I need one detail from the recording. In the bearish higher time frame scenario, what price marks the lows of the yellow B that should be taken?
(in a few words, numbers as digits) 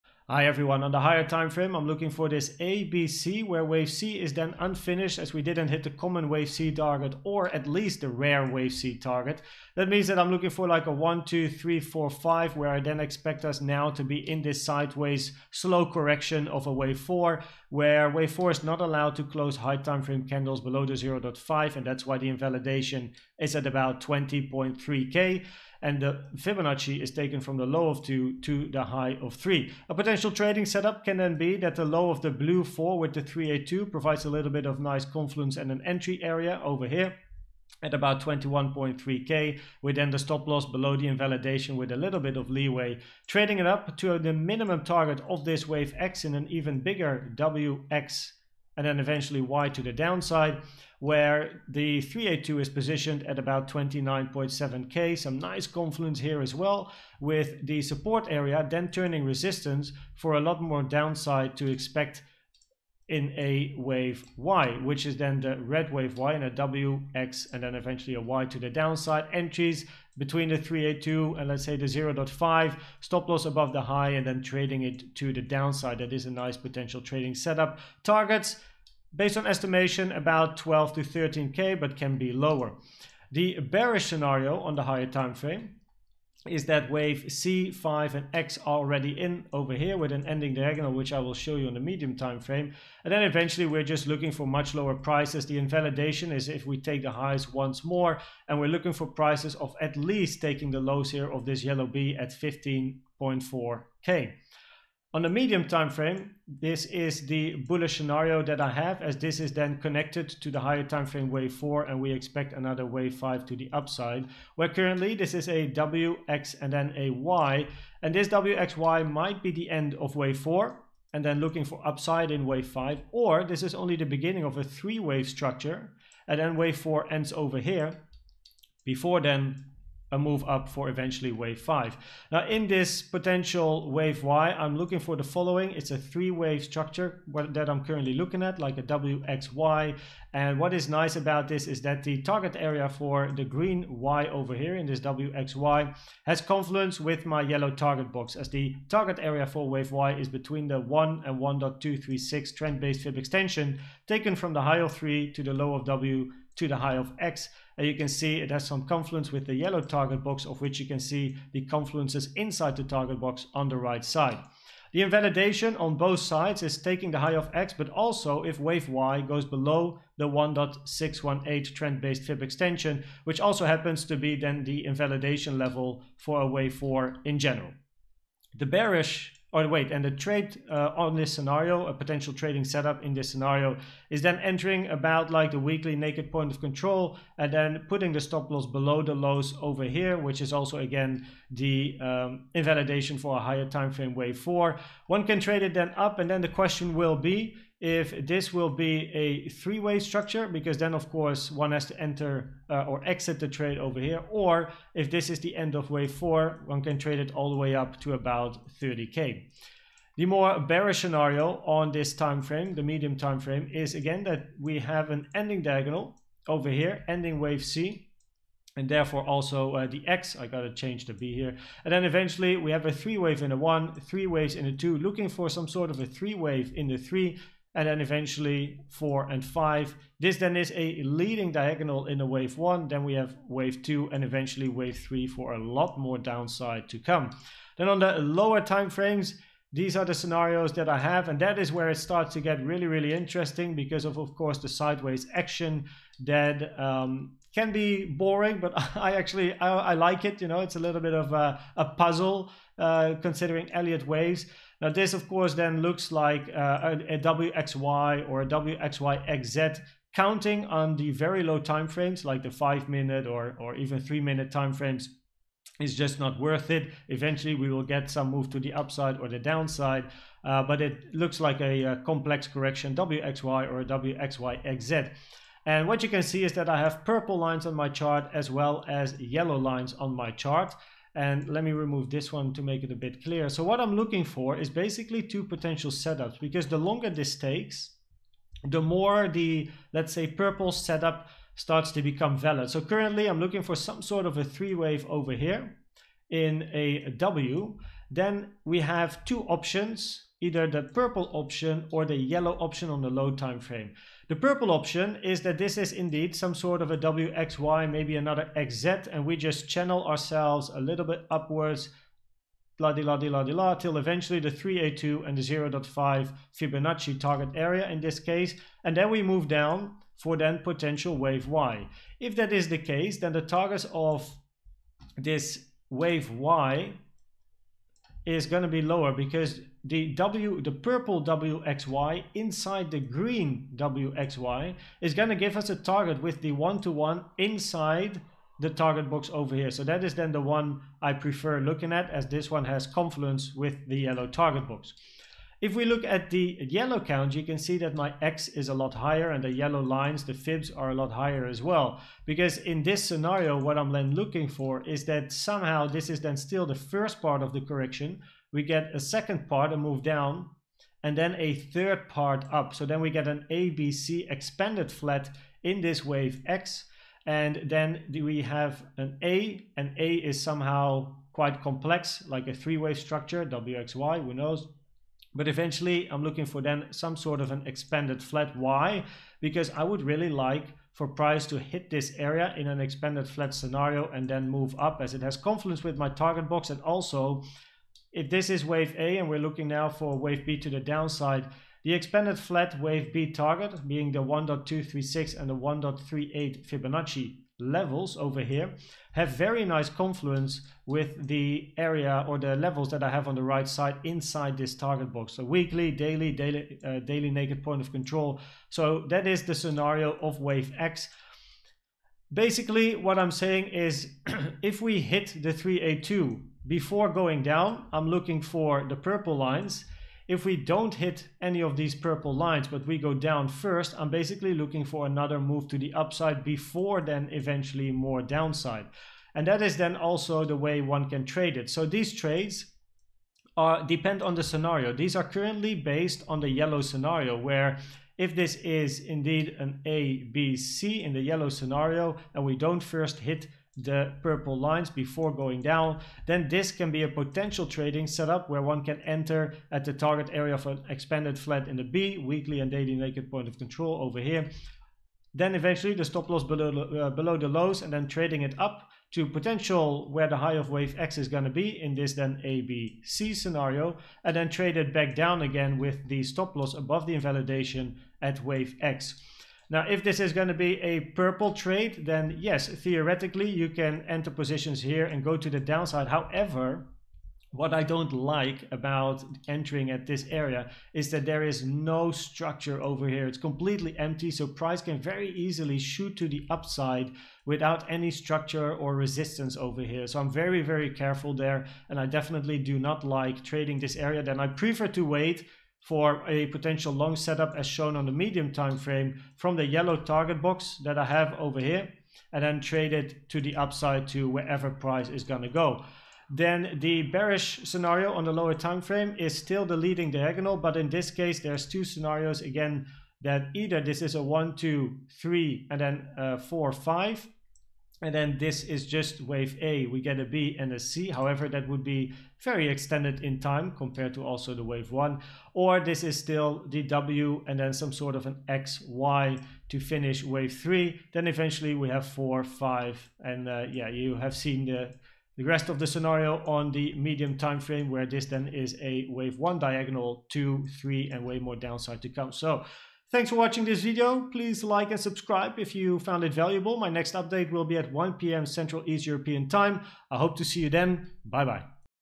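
15.4K.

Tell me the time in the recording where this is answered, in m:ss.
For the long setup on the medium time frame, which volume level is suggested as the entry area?
3:05.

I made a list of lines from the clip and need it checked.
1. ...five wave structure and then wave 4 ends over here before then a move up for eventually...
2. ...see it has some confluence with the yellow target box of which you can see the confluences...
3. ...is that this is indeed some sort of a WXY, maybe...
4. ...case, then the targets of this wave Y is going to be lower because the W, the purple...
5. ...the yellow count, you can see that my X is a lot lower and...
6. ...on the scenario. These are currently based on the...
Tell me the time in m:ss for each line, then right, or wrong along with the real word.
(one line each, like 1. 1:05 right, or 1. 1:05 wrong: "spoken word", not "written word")
1. 2:04 wrong: "three", not "five"
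2. 2:38 right
3. 5:05 right
4. 5:22 right
5. 5:46 wrong: "higher", not "lower"
6. 7:14 right.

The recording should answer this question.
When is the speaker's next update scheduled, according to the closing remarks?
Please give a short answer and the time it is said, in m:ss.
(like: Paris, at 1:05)
1 p.m., at 9:07.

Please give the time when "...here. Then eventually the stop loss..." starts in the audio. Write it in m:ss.
7:34.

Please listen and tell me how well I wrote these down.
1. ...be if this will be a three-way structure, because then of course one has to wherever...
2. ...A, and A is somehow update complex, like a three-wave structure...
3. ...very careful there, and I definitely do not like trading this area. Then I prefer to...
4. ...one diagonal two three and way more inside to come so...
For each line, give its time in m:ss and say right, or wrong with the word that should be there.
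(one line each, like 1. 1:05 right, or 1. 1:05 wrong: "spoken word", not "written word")
1. 3:17 wrong: "enter", not "wherever"
2. 6:09 wrong: "quite", not "update"
3. 8:10 right
4. 8:59 wrong: "downside", not "inside".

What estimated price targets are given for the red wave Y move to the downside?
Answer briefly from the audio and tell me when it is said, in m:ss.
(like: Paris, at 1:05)
12 to 13K, at 1:20.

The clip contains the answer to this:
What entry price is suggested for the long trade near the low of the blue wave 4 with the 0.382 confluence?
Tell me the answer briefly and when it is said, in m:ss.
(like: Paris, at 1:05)
21.3k, at 0:38.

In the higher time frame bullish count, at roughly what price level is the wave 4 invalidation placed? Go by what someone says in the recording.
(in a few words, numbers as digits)
20.3k.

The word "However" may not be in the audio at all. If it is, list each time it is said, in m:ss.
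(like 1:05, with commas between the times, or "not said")
7:56, 8:41.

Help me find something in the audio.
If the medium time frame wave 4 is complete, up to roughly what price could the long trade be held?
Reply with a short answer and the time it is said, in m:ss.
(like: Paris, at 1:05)
30K, at 3:28.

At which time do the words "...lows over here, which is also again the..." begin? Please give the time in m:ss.
3:09.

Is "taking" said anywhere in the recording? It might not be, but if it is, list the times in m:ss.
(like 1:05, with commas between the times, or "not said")
1:40, 2:46.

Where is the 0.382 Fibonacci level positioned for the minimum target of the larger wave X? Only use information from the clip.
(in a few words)
29.7K.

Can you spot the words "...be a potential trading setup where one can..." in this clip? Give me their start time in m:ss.
7:26.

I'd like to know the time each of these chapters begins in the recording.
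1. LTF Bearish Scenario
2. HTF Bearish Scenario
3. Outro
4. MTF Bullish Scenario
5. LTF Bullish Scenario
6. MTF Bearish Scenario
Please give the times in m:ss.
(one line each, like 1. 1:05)
1. 8:26
2. 1:23
3. 9:03
4. 1:45
5. 3:57
6. 3:29.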